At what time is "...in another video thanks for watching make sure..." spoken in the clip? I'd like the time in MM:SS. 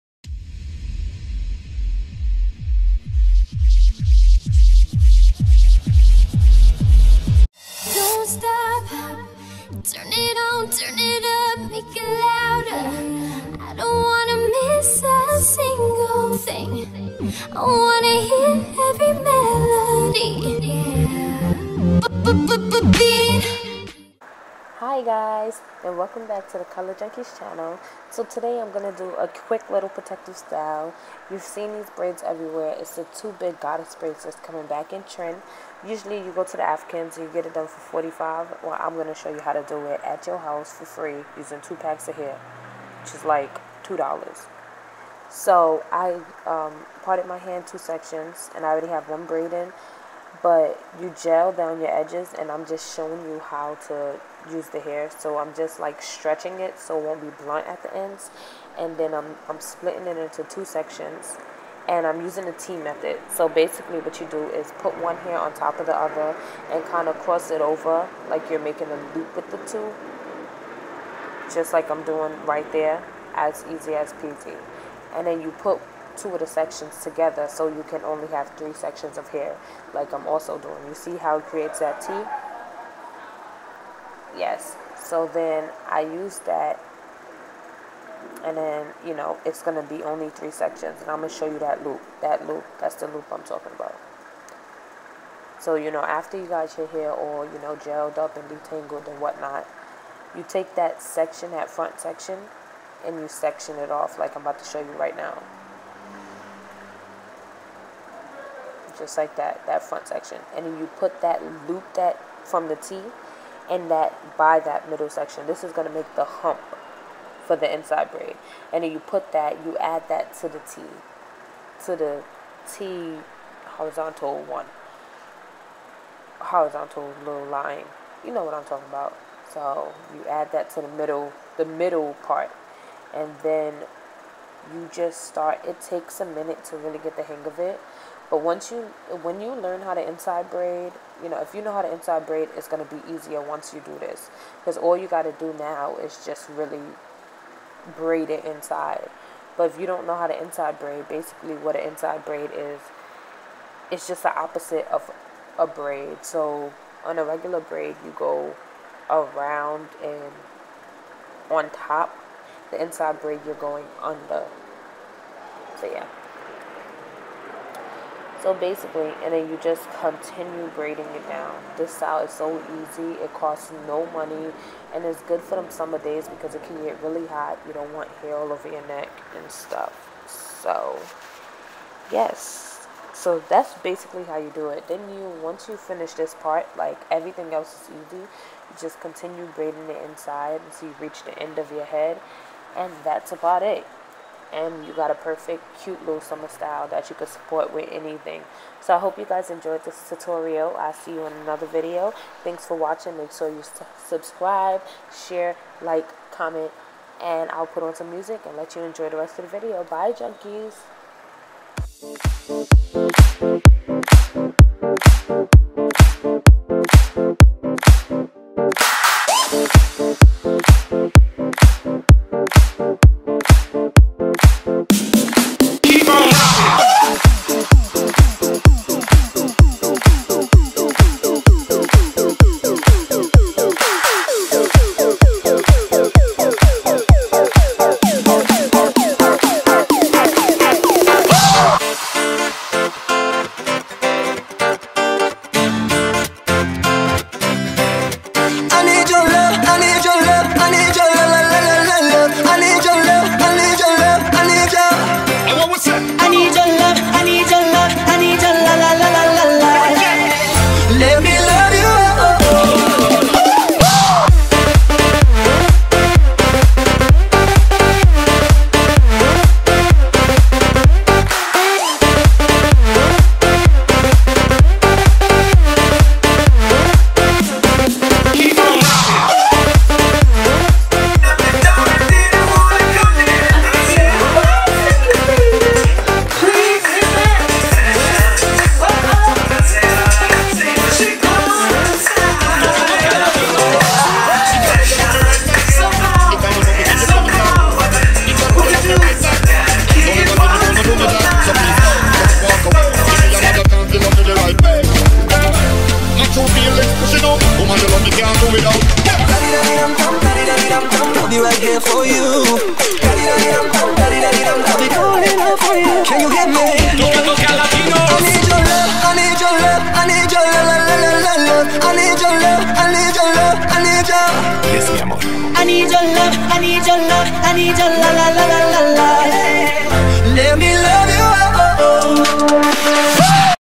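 03:21.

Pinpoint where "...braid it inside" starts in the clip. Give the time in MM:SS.
02:27.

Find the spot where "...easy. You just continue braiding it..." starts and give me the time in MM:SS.
03:08.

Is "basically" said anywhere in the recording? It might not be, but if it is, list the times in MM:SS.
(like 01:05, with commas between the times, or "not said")
01:03, 02:31, 02:48, 03:03.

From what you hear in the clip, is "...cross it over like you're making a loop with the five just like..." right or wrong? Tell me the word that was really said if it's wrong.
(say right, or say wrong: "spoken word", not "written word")
wrong: "two", not "five".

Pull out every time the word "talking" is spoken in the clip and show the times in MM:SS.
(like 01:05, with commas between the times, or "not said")
01:33, 02:08.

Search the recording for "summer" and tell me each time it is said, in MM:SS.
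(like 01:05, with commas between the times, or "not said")
02:55, 03:16.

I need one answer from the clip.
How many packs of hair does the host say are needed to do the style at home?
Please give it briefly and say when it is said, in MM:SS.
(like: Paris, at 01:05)
2, at 00:41.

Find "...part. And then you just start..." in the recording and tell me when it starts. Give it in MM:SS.
02:12.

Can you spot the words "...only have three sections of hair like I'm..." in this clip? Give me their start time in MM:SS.
01:18.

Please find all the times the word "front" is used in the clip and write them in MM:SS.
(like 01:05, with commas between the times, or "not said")
01:41, 01:49.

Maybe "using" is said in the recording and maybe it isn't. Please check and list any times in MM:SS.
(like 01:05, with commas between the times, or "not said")
00:41, 01:02.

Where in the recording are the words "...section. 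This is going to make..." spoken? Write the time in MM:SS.
01:55.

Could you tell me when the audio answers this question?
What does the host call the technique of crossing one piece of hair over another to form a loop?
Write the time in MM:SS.
01:02.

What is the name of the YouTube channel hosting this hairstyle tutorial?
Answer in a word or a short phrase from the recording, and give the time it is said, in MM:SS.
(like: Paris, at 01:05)
Color Junkies, at 00:26.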